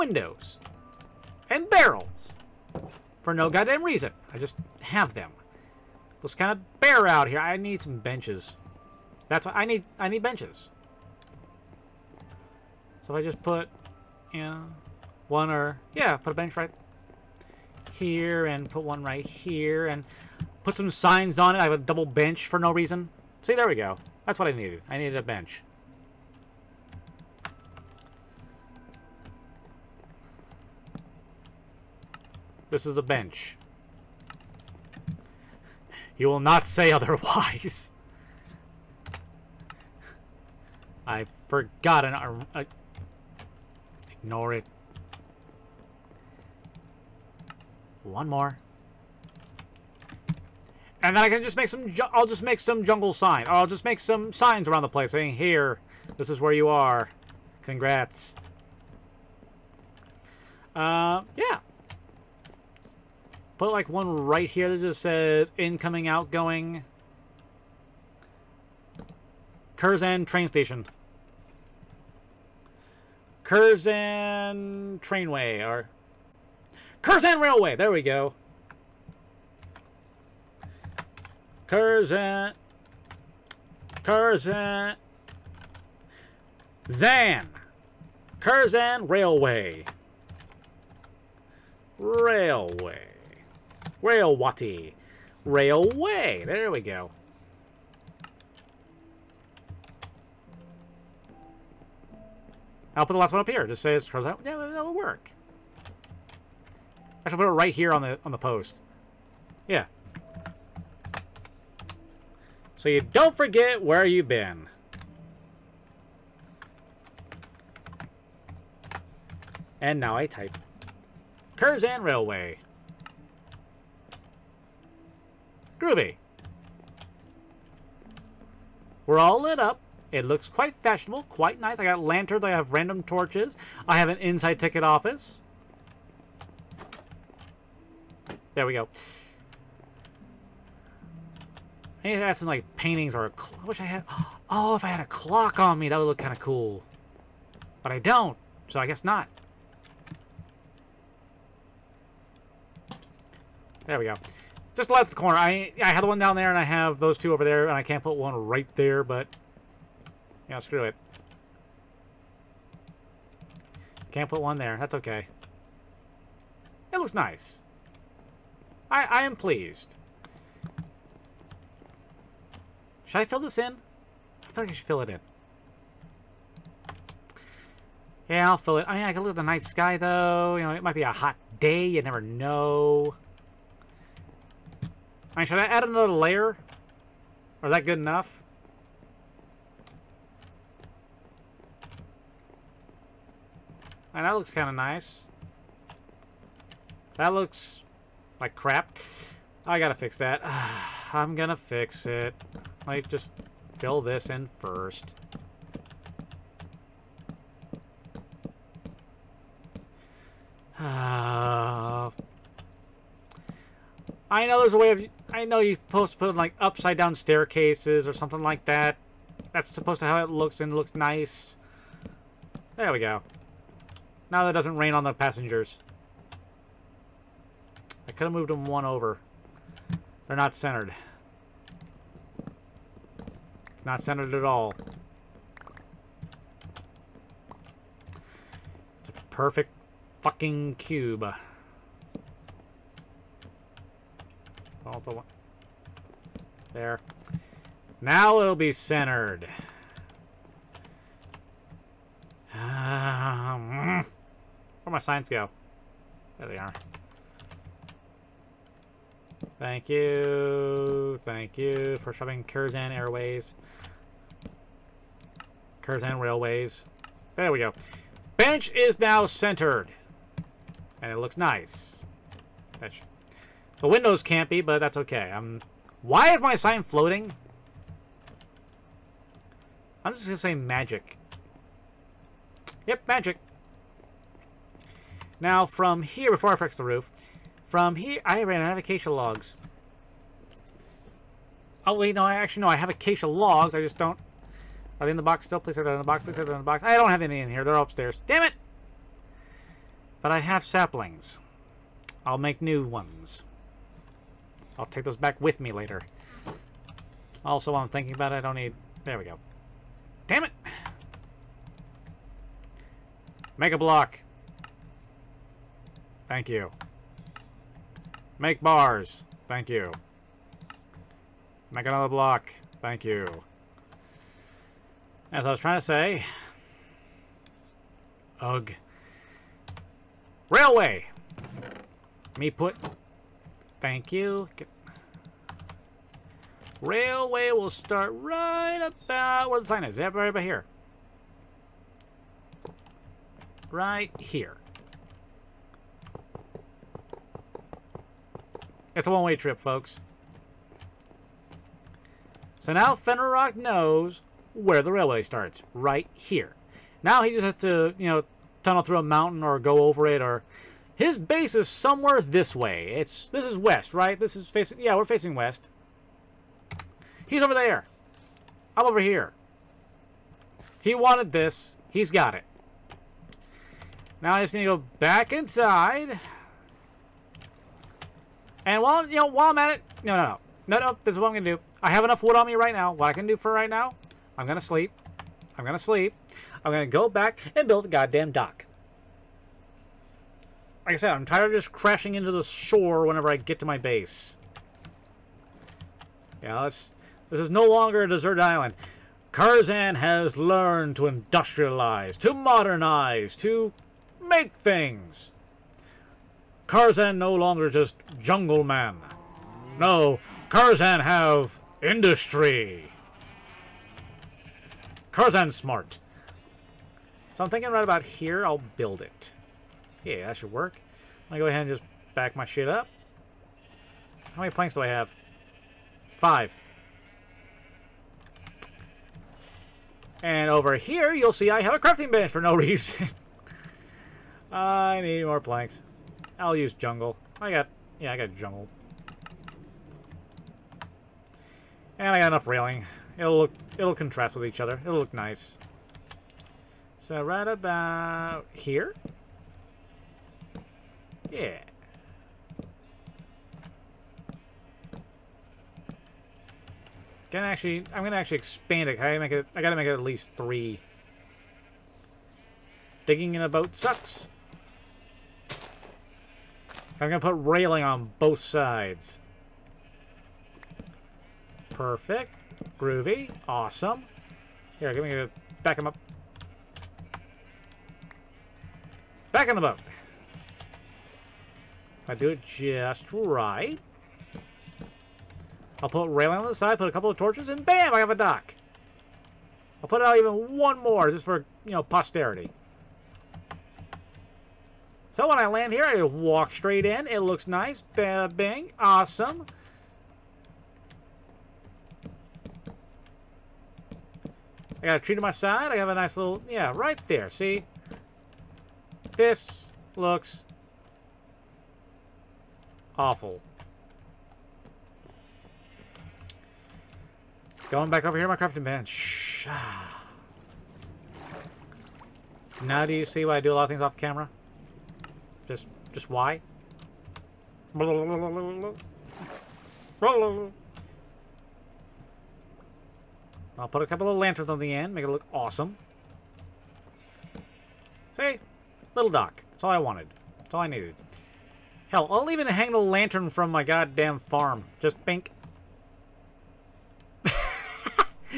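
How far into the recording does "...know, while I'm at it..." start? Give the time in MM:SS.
06:19.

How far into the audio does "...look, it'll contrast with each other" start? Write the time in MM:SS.
07:23.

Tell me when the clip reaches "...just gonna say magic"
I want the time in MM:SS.
04:40.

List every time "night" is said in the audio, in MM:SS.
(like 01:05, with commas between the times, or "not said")
02:59.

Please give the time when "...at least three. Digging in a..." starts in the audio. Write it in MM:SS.
07:39.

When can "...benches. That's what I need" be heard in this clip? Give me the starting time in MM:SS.
00:07.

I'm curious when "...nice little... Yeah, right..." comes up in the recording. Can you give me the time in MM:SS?
08:25.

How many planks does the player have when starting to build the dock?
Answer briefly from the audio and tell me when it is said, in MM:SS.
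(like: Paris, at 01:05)
5, at 07:06.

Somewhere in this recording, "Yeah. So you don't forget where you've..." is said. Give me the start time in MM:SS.
01:49.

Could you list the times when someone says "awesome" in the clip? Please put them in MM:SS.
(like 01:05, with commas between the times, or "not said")
07:53, 08:18, 08:55.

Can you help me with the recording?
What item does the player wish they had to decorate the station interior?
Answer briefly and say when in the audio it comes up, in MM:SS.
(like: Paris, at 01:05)
A clock, at 02:25.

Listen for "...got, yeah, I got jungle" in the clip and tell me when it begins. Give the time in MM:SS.
07:17.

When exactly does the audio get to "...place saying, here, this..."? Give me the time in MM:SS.
00:54.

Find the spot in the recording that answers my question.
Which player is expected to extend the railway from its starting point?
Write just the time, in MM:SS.
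05:52.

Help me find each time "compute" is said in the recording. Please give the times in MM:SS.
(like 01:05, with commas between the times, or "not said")
not said.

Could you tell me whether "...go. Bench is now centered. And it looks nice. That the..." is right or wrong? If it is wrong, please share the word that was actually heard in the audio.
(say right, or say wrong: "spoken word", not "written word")
right.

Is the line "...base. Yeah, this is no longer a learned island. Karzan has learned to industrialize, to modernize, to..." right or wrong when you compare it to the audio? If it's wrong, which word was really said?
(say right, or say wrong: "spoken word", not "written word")
wrong: "deserted", not "learned".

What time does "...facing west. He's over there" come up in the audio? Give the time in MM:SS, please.
06:05.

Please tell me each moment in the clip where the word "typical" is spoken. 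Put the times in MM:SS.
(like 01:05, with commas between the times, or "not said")
not said.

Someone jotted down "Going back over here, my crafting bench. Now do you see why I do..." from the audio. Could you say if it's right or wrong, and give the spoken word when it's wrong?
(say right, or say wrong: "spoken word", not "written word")
right.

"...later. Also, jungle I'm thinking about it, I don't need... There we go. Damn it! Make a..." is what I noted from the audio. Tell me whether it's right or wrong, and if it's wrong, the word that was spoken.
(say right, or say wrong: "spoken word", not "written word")
wrong: "while", not "jungle".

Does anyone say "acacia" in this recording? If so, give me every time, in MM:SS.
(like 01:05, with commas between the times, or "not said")
04:48, 04:52.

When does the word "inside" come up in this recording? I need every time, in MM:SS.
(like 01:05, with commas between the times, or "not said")
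02:14, 06:15.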